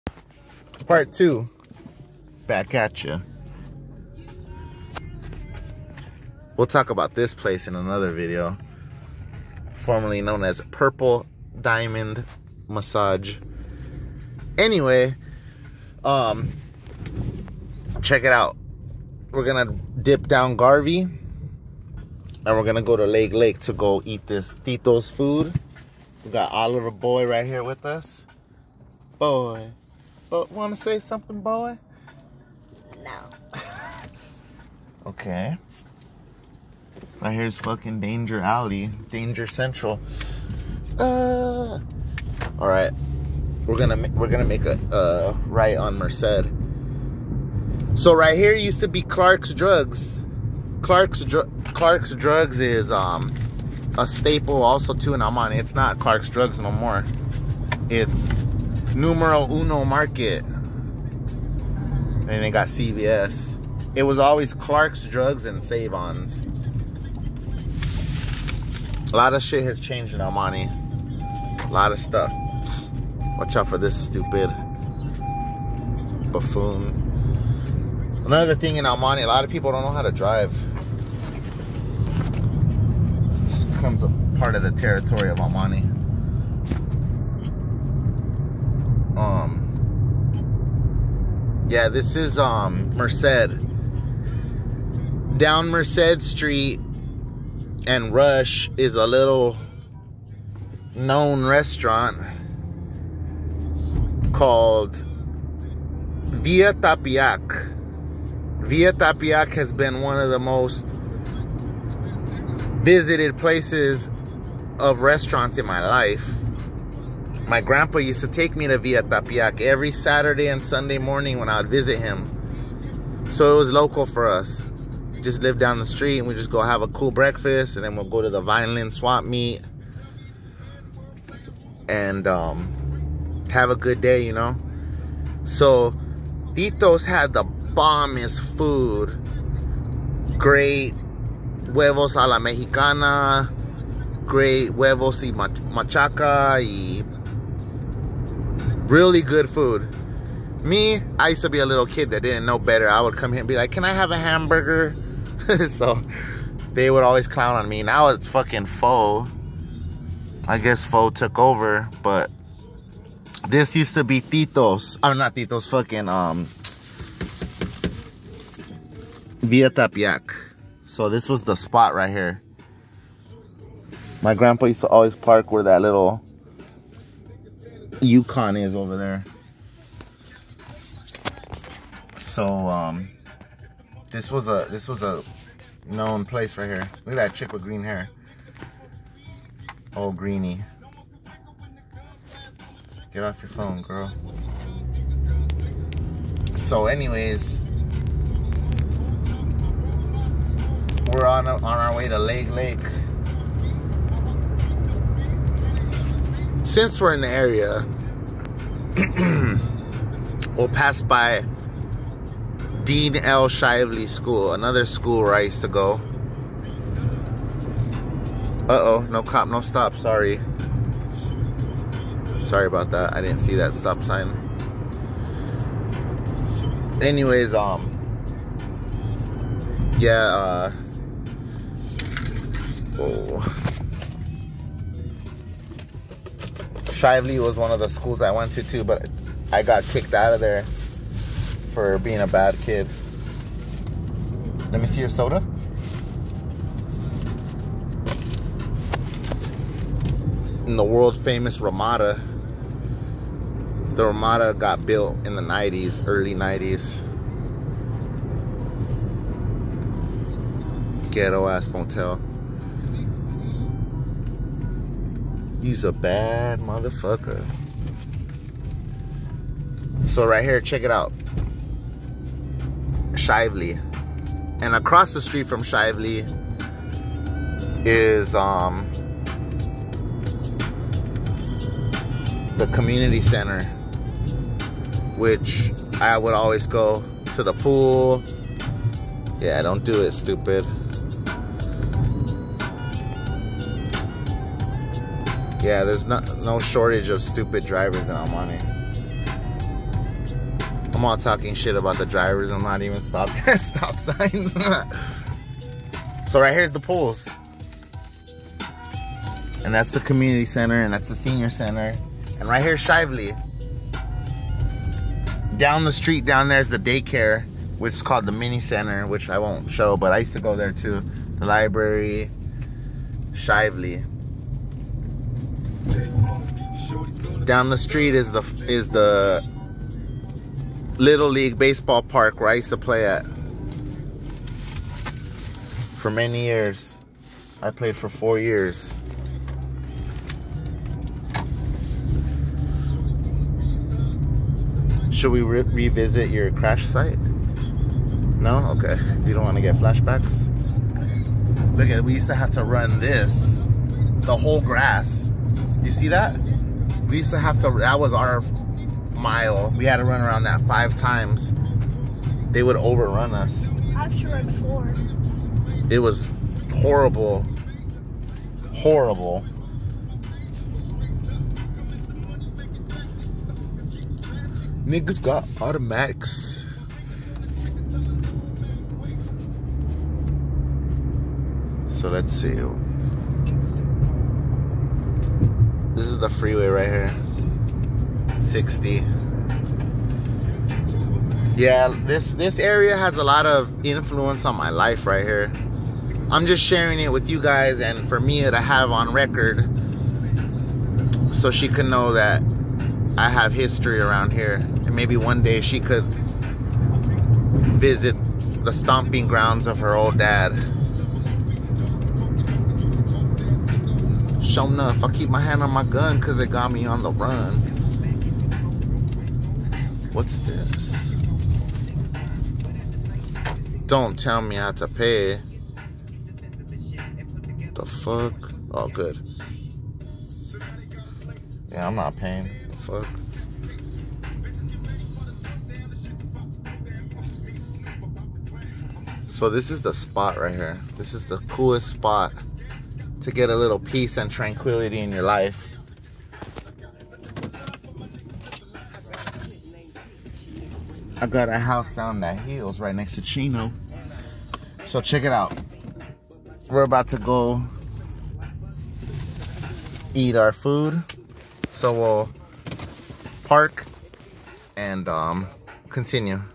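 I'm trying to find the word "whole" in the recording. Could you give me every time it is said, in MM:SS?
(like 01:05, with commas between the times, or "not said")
05:54.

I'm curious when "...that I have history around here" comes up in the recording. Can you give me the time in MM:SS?
06:42.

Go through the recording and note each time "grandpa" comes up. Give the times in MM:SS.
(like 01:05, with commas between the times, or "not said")
01:57, 02:54.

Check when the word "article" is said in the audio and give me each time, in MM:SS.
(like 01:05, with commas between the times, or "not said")
not said.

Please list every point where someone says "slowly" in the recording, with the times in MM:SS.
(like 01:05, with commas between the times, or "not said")
not said.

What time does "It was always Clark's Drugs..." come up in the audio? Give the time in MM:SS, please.
01:03.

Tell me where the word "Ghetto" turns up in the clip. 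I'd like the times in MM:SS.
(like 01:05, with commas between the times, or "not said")
04:21.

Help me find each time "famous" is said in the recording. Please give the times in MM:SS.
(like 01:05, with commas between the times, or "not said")
04:11.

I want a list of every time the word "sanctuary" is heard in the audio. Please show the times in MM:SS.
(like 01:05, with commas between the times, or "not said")
not said.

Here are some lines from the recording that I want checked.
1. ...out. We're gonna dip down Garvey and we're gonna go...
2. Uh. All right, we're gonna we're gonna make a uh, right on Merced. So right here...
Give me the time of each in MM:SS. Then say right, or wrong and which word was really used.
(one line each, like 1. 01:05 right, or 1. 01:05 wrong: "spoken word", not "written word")
1. 00:18 right
2. 00:40 right.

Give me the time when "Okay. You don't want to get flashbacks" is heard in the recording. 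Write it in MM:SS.
05:48.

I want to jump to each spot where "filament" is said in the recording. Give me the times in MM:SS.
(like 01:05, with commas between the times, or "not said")
not said.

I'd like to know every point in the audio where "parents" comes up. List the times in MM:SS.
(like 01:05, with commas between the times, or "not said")
not said.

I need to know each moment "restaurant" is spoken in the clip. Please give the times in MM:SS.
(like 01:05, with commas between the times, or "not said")
01:41, 01:54.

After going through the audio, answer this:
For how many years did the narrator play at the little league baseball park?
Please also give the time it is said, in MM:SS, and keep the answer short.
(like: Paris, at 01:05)
4, at 05:38.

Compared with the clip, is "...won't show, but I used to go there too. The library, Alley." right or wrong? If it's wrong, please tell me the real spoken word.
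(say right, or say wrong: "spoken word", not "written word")
wrong: "Shively", not "Alley".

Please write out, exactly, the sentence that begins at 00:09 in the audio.
Formerly known as Purple Diamond Massage.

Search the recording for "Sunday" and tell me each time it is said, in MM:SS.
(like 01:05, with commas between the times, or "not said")
02:00.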